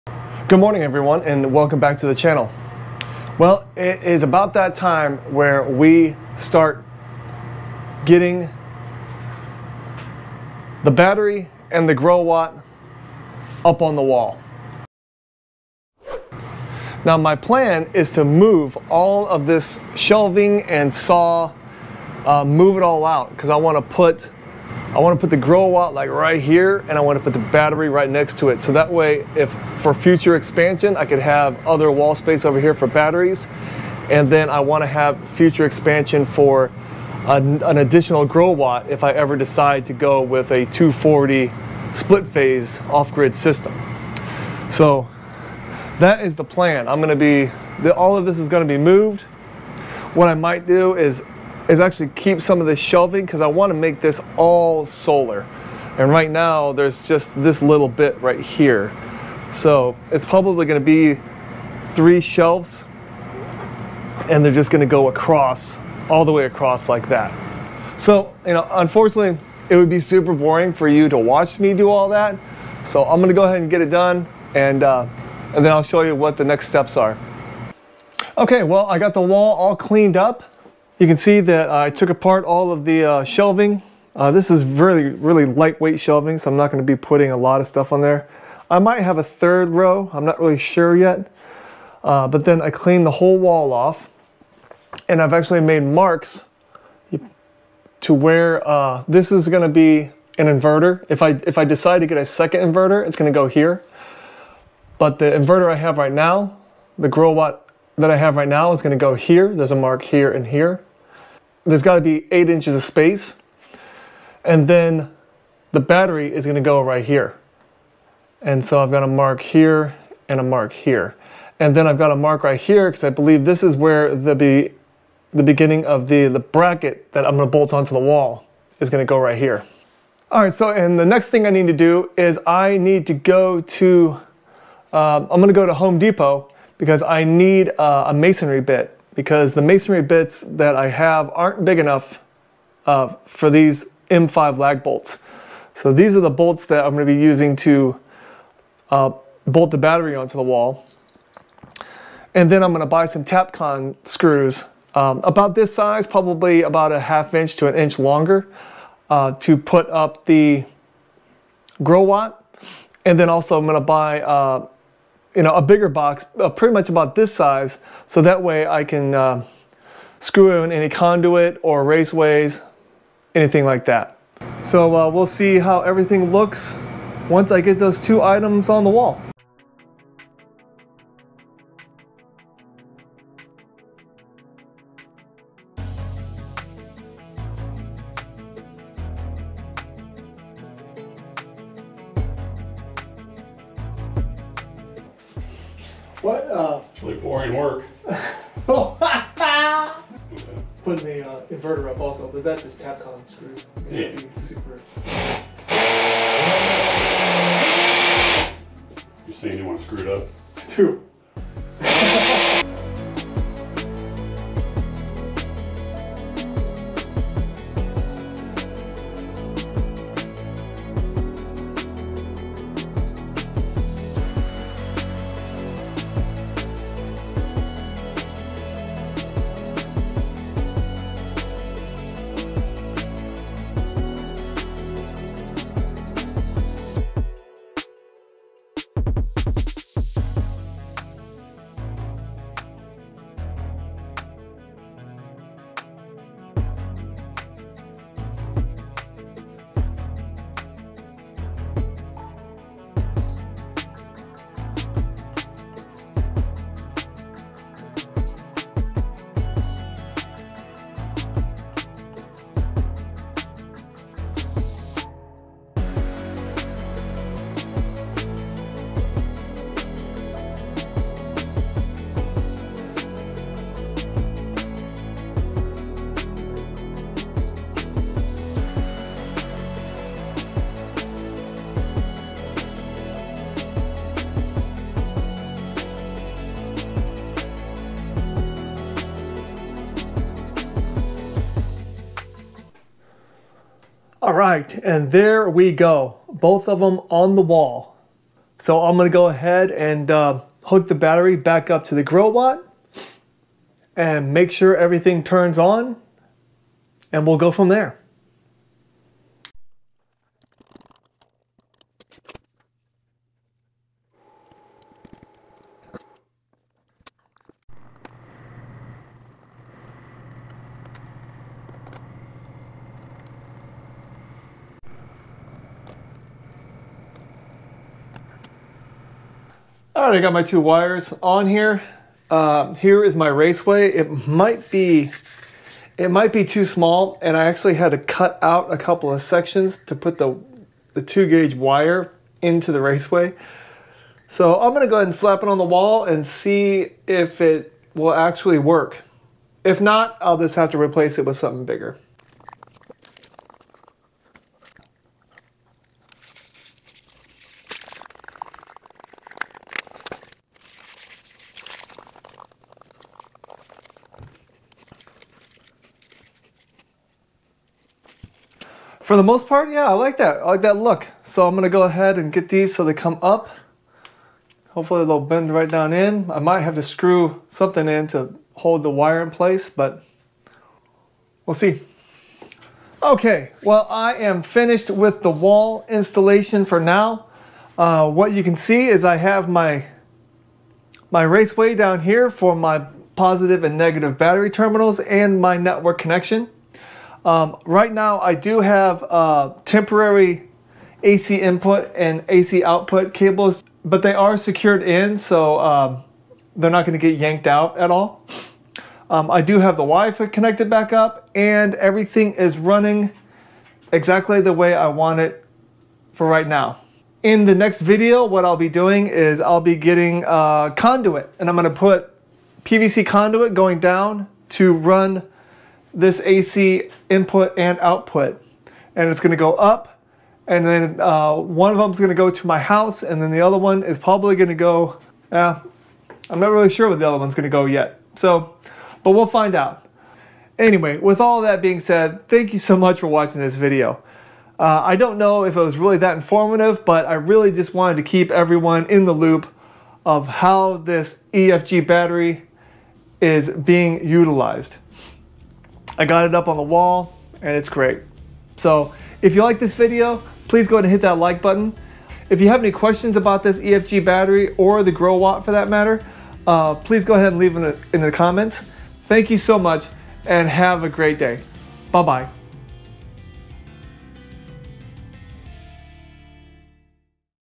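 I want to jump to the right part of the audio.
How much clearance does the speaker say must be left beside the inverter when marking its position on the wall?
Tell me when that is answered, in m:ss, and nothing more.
1:52.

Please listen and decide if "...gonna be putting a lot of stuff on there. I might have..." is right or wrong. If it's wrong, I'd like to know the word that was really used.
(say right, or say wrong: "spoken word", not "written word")
right.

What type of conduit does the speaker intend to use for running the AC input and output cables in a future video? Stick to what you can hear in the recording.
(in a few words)
PVC.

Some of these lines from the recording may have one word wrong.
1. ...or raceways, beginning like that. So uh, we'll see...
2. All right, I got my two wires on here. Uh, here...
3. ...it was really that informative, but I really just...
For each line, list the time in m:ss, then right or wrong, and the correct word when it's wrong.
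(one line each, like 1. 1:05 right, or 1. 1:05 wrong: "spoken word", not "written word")
1. 2:51 wrong: "anything", not "beginning"
2. 5:29 right
3. 7:25 right.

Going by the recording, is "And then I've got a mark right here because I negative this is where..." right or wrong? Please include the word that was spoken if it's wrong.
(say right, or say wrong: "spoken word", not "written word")
wrong: "believe", not "negative".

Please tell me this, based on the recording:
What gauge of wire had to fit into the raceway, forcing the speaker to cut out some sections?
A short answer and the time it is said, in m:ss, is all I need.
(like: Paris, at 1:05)
2 gauge, at 5:41.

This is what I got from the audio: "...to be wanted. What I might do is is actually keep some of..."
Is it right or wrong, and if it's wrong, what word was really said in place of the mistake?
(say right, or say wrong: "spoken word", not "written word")
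wrong: "moved", not "wanted".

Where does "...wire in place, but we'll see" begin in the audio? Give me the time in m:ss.
6:18.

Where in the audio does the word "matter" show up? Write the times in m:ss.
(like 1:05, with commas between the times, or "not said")
7:45.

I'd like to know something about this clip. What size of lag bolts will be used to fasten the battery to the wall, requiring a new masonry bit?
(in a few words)
M5.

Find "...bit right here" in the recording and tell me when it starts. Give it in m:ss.
0:57.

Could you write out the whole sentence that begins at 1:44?
But the inverter I have right now, the Growatt that I have right now is going to go here.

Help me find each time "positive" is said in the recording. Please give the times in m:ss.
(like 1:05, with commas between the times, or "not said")
6:33.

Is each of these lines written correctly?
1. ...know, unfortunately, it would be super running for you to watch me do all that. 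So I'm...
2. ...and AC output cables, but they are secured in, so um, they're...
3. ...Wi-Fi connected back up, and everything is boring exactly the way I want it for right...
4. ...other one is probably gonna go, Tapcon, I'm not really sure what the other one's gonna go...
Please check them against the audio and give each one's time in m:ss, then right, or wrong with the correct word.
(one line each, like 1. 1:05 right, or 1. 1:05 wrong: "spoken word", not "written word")
1. 1:08 wrong: "boring", not "running"
2. 6:41 right
3. 6:49 wrong: "running", not "boring"
4. 7:13 wrong: "Yeah", not "Tapcon".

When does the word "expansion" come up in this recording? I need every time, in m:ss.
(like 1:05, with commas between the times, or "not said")
0:30, 0:35.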